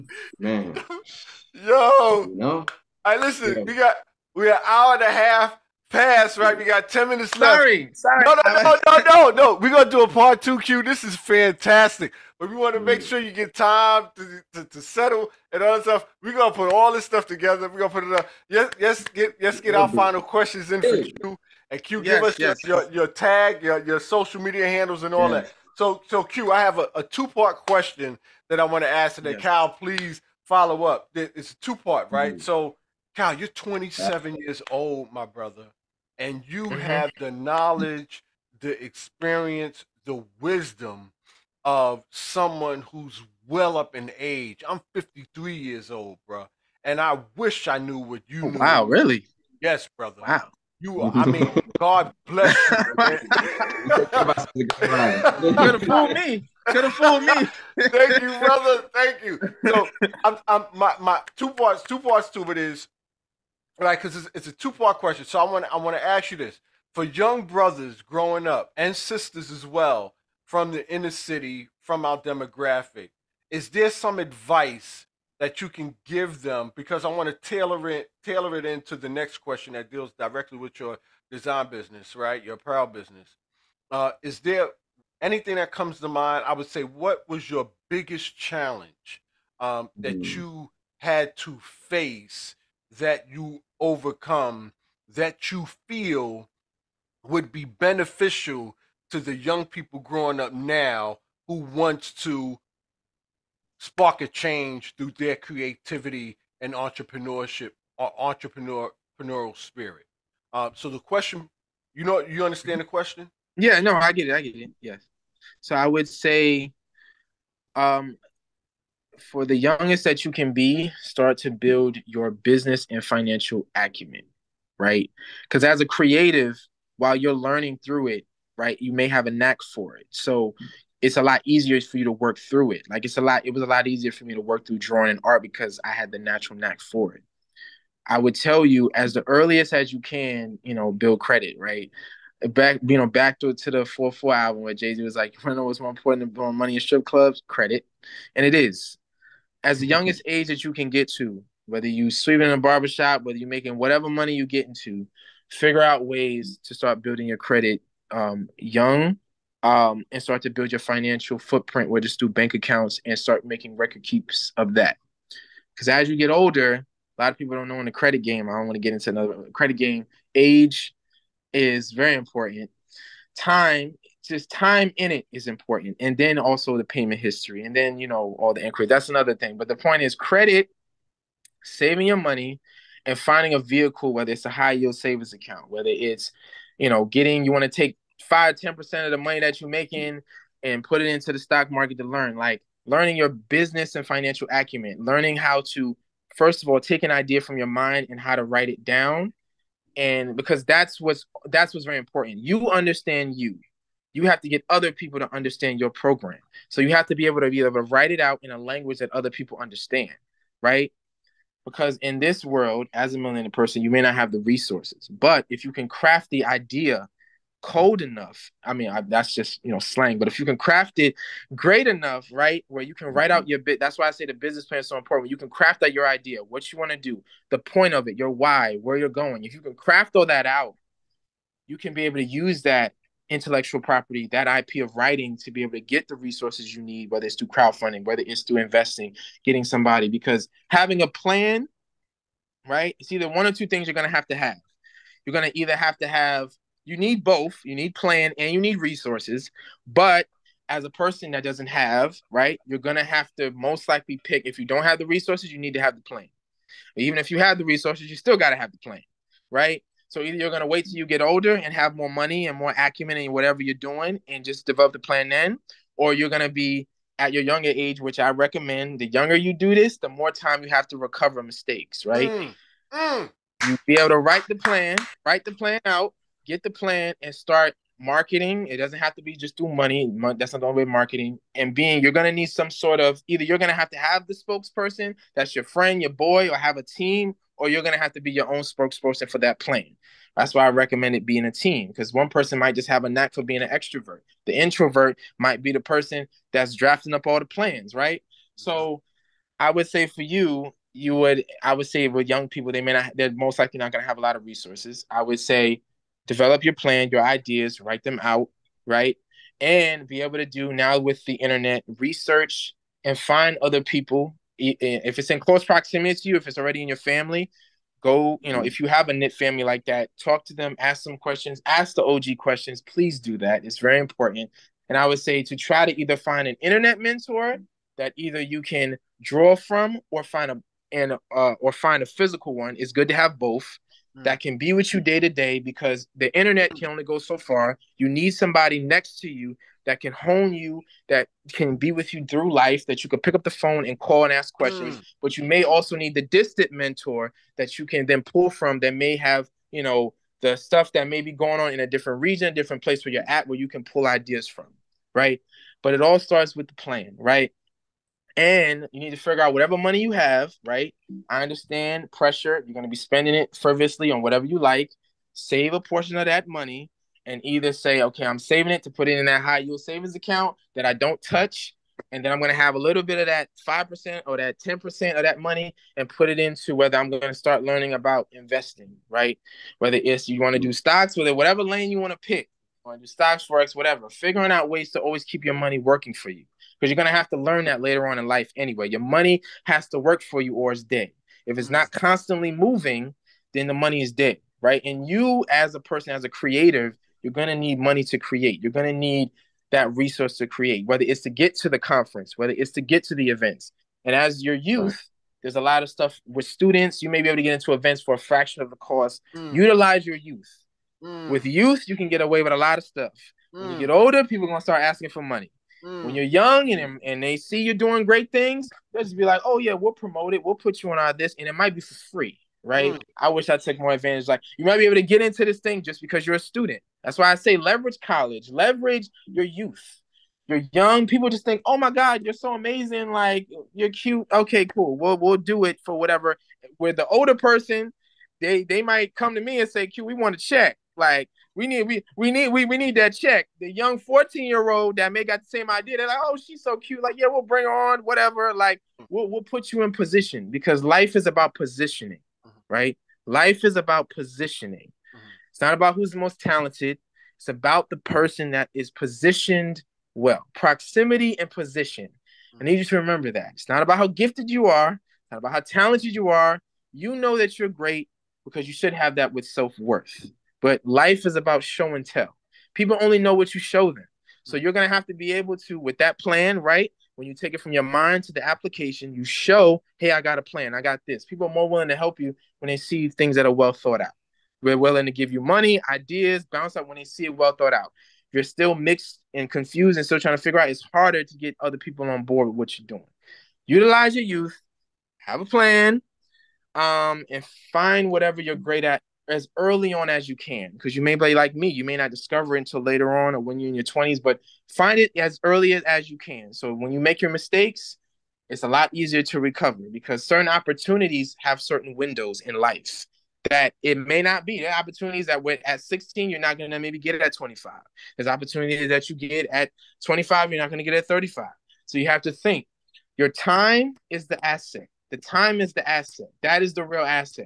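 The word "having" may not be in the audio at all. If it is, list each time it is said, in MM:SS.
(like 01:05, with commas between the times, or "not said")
04:00.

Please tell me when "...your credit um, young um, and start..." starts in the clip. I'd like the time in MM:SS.
02:37.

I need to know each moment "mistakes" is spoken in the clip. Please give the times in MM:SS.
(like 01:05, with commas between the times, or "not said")
04:31, 08:27.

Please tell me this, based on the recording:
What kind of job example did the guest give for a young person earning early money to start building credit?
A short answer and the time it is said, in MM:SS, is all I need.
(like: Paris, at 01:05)
Sweeping in a barbershop, at 02:32.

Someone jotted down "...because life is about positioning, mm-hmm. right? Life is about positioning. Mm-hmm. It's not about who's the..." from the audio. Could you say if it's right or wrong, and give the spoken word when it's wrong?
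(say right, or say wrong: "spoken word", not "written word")
right.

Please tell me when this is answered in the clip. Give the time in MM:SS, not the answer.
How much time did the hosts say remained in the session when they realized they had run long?
00:06.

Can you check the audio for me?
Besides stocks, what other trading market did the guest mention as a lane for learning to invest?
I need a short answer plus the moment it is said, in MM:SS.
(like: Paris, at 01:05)
Forex, at 06:23.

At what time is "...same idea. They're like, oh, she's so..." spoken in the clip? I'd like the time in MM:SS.
07:25.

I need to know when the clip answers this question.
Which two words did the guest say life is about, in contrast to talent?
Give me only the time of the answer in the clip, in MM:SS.
07:40.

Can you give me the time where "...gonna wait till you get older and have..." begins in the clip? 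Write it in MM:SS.
04:20.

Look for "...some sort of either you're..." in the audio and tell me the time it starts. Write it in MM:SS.
04:42.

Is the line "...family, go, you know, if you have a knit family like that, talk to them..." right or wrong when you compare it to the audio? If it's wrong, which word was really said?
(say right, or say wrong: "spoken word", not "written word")
right.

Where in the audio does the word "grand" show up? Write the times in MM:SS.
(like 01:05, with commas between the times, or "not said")
not said.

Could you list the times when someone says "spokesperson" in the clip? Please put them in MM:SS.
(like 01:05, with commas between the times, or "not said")
04:44, 04:48.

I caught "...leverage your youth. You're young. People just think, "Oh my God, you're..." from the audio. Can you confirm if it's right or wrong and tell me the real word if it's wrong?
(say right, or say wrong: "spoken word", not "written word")
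right.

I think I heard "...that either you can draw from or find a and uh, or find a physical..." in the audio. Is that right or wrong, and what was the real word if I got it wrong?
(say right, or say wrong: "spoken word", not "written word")
right.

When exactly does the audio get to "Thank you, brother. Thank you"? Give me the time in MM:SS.
00:57.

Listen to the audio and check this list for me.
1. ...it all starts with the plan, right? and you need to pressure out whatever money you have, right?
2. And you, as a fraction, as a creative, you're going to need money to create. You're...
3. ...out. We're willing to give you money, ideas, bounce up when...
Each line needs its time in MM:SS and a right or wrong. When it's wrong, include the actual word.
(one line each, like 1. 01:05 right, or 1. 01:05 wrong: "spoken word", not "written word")
1. 05:55 wrong: "figure", not "pressure"
2. 06:34 wrong: "person", not "fraction"
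3. 08:03 right.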